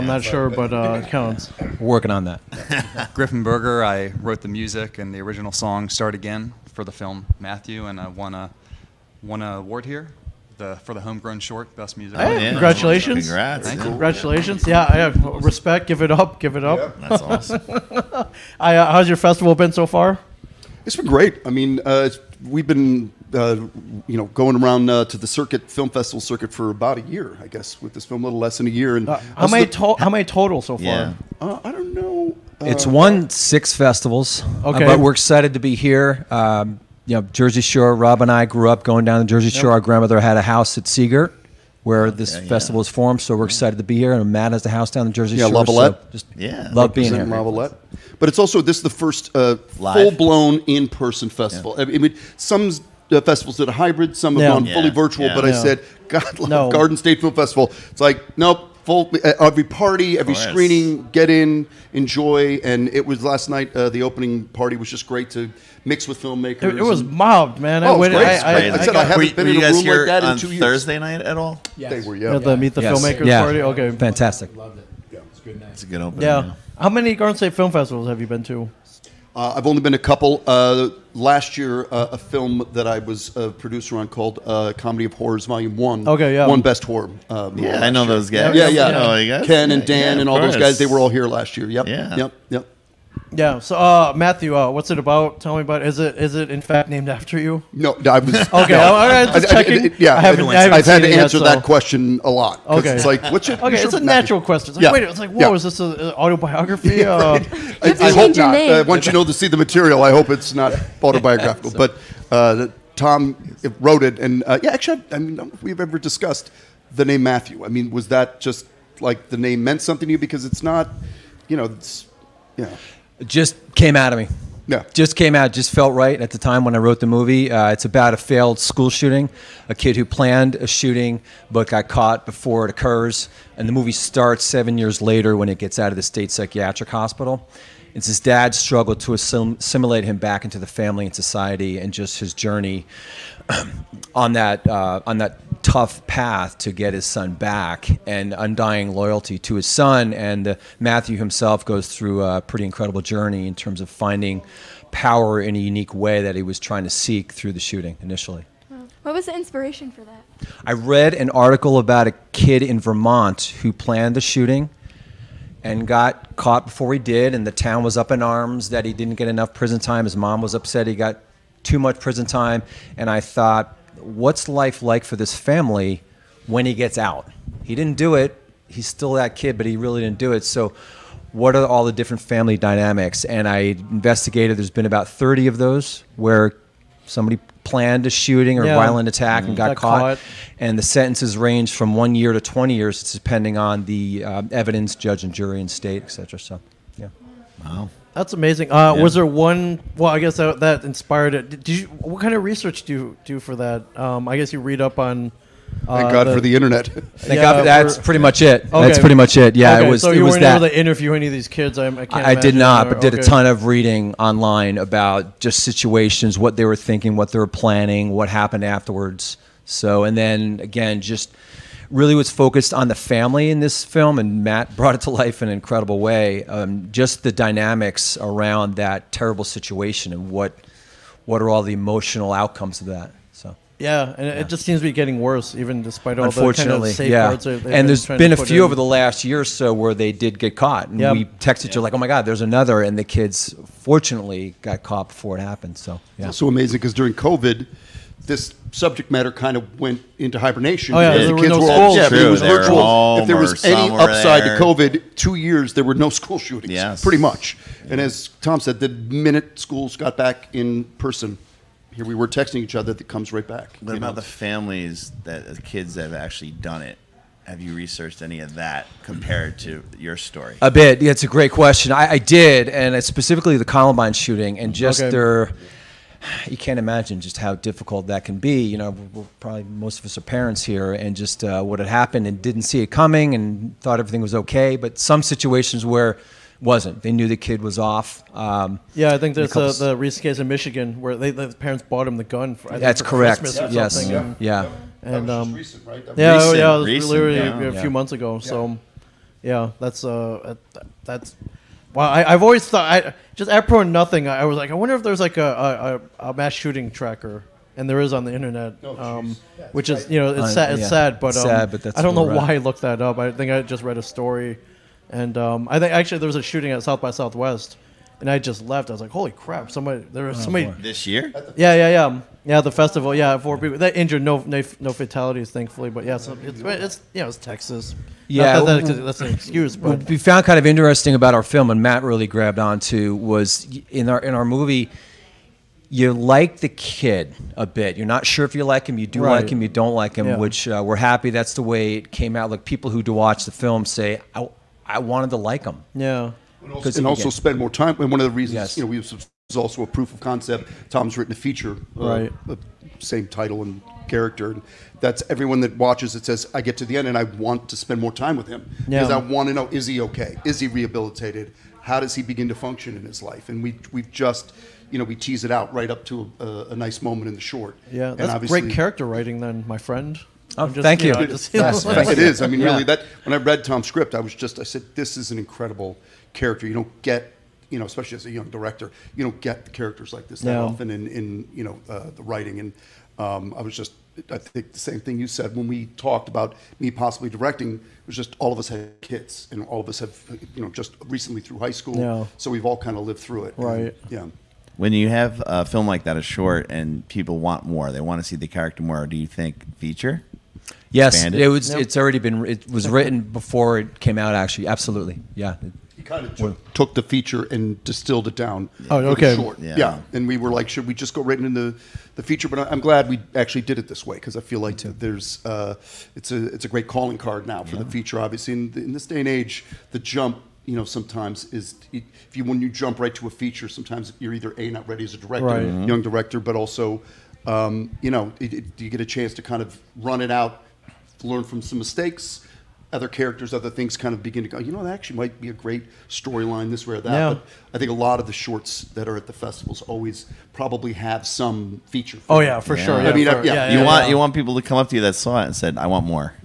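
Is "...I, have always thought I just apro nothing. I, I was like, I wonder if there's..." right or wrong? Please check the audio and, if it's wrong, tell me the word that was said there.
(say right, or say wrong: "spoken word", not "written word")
right.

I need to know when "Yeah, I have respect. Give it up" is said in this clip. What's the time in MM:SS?
00:14.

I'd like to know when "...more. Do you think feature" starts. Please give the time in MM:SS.
06:38.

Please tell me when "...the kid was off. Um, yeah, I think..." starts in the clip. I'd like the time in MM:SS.
04:47.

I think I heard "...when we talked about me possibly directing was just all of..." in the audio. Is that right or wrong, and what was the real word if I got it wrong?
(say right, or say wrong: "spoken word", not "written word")
right.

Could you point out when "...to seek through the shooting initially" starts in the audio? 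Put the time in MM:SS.
02:36.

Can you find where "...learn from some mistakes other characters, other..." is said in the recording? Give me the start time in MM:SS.
07:11.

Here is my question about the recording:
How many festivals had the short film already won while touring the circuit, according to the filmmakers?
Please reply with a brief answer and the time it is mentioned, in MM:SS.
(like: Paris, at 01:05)
6, at 00:32.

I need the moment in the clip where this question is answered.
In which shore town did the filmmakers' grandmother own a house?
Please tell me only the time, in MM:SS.
00:40.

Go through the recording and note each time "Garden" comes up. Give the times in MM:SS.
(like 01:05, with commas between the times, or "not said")
00:56, 01:17.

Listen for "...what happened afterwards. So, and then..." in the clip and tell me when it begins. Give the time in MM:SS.
03:38.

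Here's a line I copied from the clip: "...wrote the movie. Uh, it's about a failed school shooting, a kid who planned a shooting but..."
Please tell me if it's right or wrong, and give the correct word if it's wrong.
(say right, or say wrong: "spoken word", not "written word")
right.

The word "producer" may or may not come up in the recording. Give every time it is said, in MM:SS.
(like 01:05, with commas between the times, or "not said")
01:23.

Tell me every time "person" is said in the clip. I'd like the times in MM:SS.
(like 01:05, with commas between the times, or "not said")
00:50, 04:20.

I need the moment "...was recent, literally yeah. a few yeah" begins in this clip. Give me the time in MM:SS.
04:56.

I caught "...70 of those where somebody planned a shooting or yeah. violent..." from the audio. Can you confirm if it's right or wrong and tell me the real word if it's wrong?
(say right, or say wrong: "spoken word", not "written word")
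wrong: "30", not "70".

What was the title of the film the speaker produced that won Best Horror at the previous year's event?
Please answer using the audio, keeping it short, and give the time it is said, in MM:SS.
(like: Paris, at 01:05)
Comedy of Horrors Volume 1, at 01:24.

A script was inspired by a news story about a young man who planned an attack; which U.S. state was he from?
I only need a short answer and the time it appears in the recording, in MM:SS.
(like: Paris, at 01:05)
Vermont, at 02:42.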